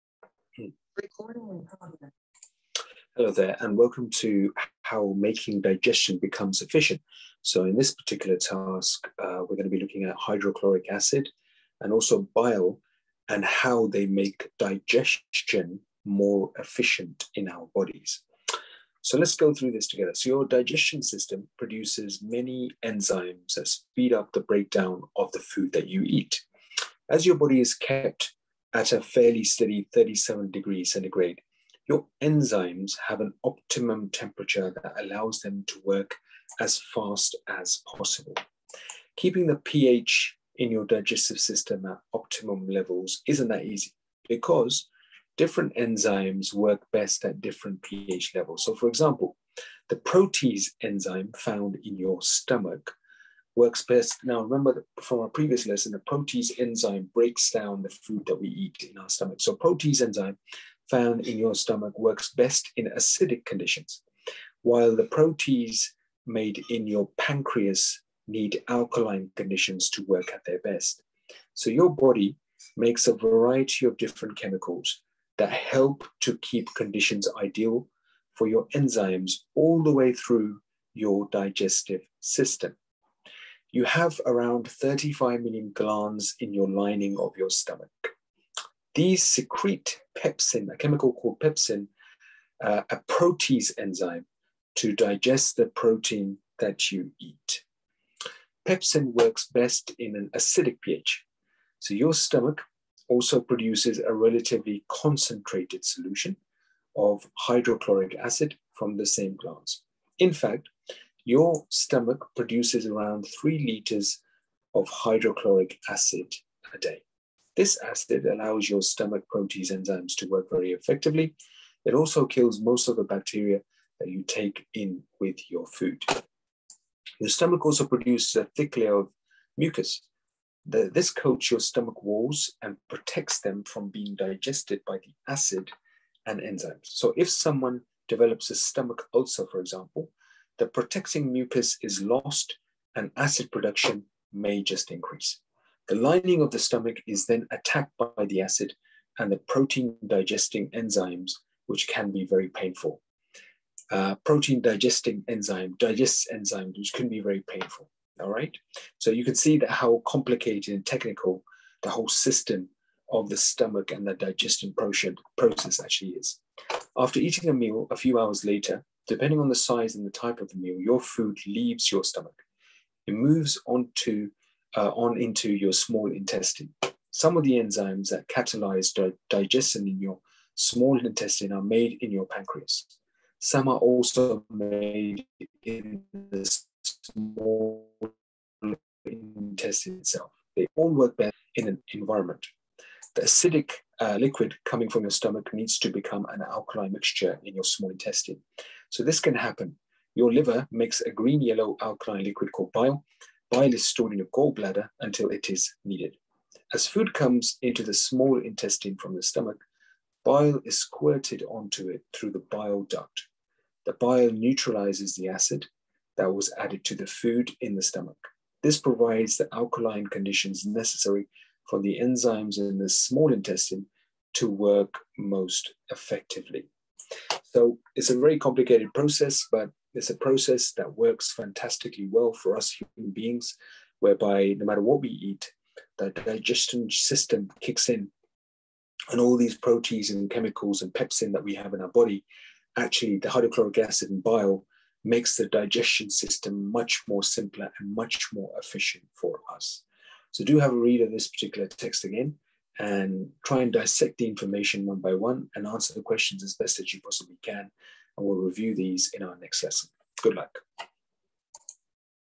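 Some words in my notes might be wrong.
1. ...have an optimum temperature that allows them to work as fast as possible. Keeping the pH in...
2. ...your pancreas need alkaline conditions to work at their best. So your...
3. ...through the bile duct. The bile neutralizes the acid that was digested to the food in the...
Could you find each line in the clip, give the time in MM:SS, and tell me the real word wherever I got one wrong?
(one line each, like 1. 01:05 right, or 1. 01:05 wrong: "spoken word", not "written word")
1. 00:33 right
2. 01:06 right
3. 03:32 wrong: "added", not "digested".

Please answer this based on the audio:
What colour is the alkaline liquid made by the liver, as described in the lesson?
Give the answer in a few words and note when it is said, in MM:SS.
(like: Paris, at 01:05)
green yellow, at 03:21.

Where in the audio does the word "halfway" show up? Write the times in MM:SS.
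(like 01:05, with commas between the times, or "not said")
not said.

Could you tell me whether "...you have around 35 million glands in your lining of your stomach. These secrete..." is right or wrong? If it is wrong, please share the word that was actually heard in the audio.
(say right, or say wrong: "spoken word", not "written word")
right.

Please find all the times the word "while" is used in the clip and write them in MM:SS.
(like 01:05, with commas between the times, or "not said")
01:04.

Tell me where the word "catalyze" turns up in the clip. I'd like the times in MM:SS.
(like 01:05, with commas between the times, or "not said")
02:58.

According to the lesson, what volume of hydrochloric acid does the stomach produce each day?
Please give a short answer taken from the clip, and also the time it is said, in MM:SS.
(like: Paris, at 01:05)
3 liters, at 01:53.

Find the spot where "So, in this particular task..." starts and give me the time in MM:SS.
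00:07.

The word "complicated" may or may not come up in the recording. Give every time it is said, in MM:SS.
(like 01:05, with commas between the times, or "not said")
02:40, 03:48.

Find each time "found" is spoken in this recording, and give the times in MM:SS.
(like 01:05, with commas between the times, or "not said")
00:51, 01:00.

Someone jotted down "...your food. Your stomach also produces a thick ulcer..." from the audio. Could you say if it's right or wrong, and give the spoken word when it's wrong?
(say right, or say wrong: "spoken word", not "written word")
wrong: "layer", not "ulcer".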